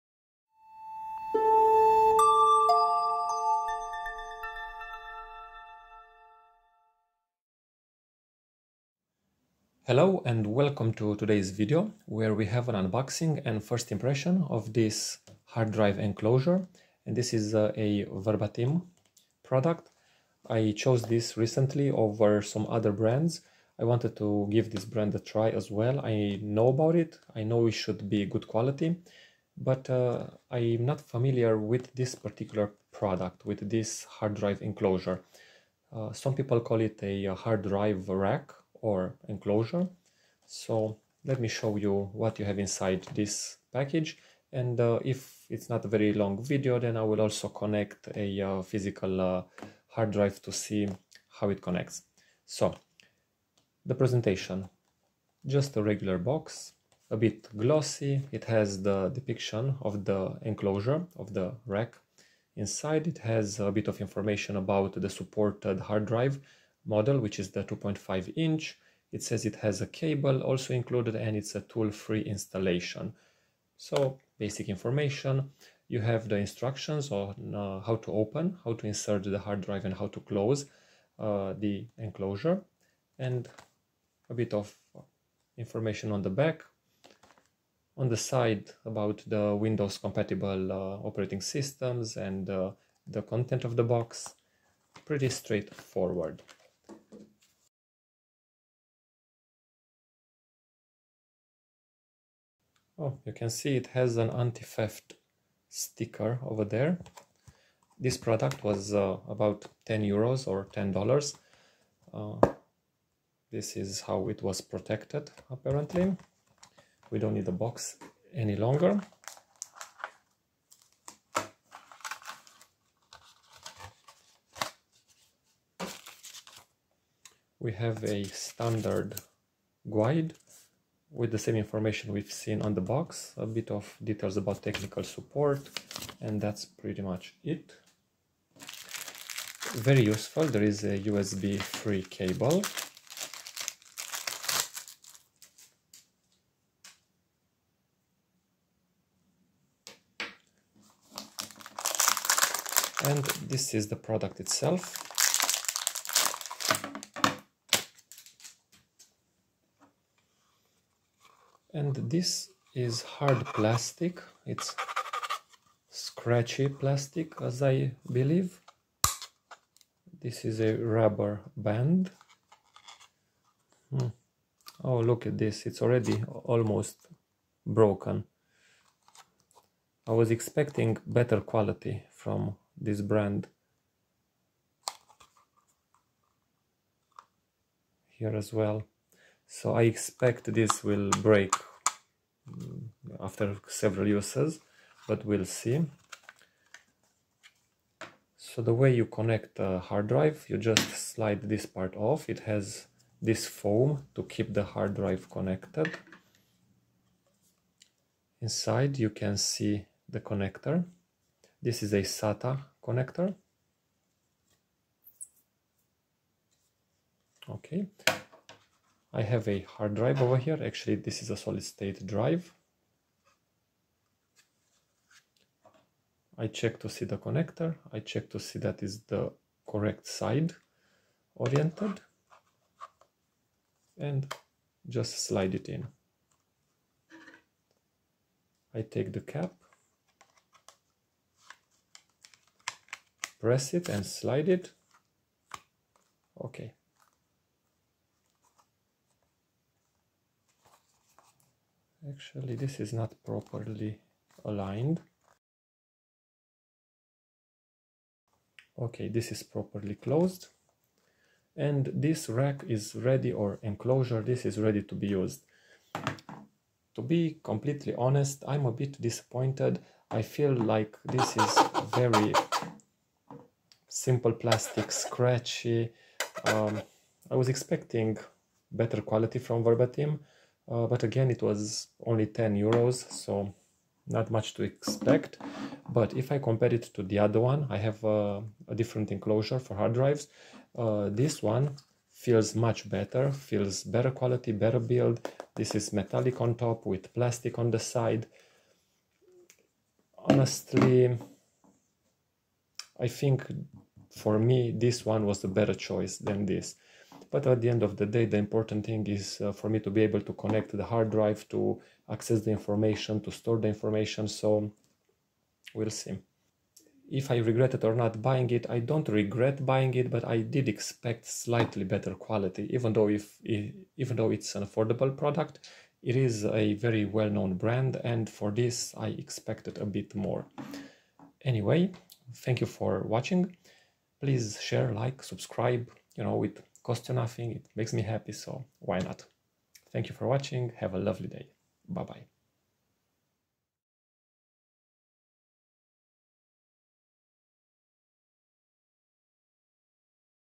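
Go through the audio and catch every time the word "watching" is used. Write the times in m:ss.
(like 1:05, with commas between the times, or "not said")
5:33, 5:40.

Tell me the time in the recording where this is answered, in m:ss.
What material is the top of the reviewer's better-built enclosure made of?
4:55.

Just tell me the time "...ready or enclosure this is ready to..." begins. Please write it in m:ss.
4:22.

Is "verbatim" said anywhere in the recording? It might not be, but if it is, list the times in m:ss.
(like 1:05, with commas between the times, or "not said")
0:18, 4:39.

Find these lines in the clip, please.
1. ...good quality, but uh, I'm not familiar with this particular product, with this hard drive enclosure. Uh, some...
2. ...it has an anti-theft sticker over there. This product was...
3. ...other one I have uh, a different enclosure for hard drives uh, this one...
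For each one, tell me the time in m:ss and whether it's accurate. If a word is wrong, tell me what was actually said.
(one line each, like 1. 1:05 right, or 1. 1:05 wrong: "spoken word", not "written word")
1. 0:28 right
2. 1:43 right
3. 4:47 right.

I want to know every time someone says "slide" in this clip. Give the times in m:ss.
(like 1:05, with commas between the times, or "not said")
3:21, 3:55, 4:04.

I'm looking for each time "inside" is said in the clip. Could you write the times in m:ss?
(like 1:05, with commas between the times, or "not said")
0:42, 1:02, 3:28.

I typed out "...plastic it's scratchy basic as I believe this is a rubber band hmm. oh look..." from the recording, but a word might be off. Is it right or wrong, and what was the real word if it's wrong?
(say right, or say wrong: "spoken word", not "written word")
wrong: "plastic", not "basic".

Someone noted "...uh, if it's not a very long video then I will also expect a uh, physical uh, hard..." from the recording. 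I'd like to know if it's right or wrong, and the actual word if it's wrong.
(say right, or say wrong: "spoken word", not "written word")
wrong: "connect", not "expect".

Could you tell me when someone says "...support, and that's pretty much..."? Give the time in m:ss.
2:15.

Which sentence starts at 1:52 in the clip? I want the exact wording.
Uh, this is how it was protected apparently.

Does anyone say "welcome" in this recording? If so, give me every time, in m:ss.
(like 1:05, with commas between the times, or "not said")
0:10.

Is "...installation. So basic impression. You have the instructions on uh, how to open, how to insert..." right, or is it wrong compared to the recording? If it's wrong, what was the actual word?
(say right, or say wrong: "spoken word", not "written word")
wrong: "information", not "impression".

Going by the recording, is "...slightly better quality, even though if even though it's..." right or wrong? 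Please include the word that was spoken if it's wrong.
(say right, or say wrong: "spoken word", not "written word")
right.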